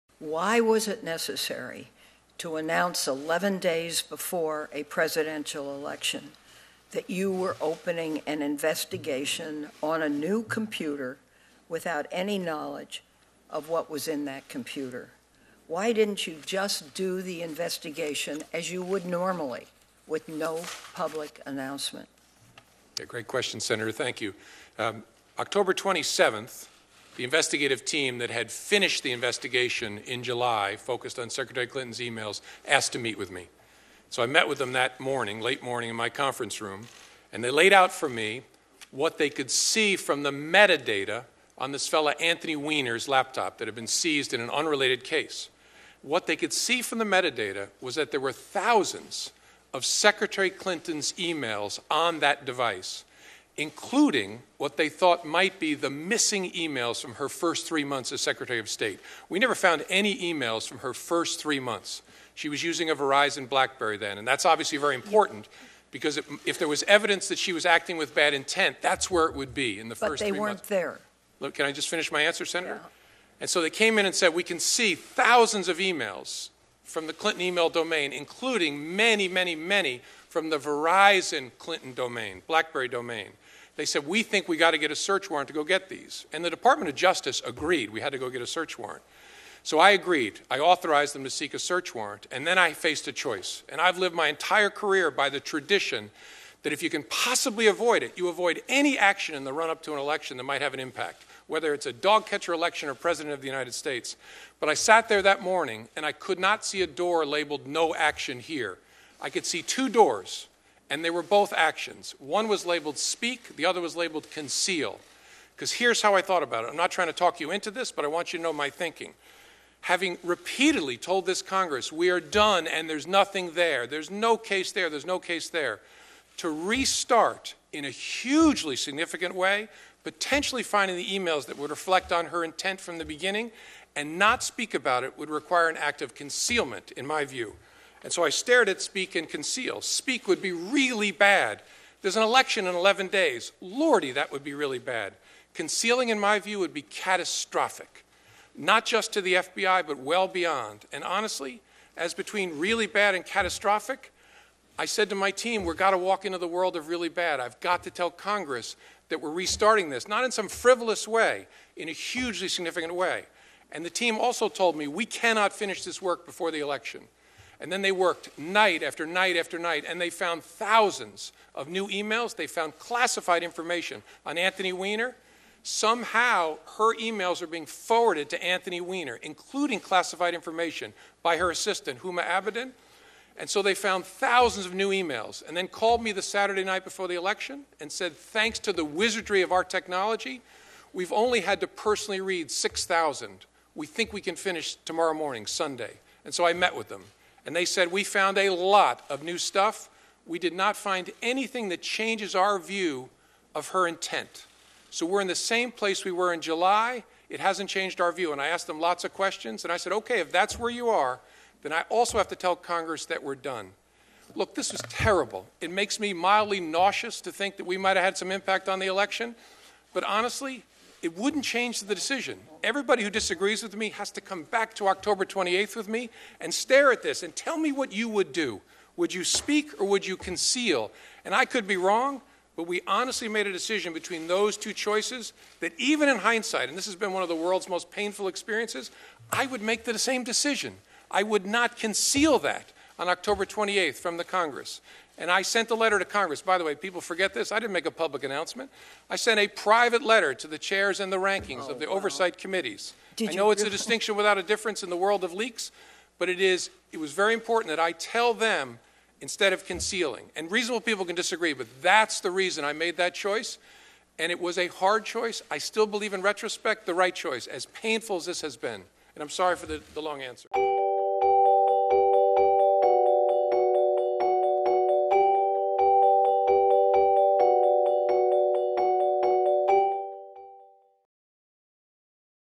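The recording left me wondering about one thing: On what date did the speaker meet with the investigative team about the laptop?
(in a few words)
October 27th.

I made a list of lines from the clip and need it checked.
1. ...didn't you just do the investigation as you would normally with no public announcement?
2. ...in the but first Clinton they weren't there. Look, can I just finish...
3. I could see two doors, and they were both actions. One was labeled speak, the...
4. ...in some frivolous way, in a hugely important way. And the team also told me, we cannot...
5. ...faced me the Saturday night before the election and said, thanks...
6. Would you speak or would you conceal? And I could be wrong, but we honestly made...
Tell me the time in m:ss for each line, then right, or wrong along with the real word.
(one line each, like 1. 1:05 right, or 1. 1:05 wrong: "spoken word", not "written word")
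1. 0:15 right
2. 1:09 wrong: "But", not "Clinton"
3. 1:49 right
4. 2:40 wrong: "significant", not "important"
5. 3:05 wrong: "called", not "faced"
6. 3:48 right.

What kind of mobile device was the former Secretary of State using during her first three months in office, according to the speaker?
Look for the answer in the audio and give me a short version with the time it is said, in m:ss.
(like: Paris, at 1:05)
Verizon Blackberry, at 1:02.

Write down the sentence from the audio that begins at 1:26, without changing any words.
And the Department of Justice agreed we had to go get a search warrant.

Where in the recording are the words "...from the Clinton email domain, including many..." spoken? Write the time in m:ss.
1:16.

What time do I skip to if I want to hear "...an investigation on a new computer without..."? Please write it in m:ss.
0:08.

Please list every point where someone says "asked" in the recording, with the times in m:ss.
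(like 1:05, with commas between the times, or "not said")
0:32, 3:28.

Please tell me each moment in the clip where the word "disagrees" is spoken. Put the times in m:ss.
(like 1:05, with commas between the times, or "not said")
3:43, 4:21.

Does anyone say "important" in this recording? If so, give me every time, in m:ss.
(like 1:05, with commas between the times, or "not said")
1:04, 4:17.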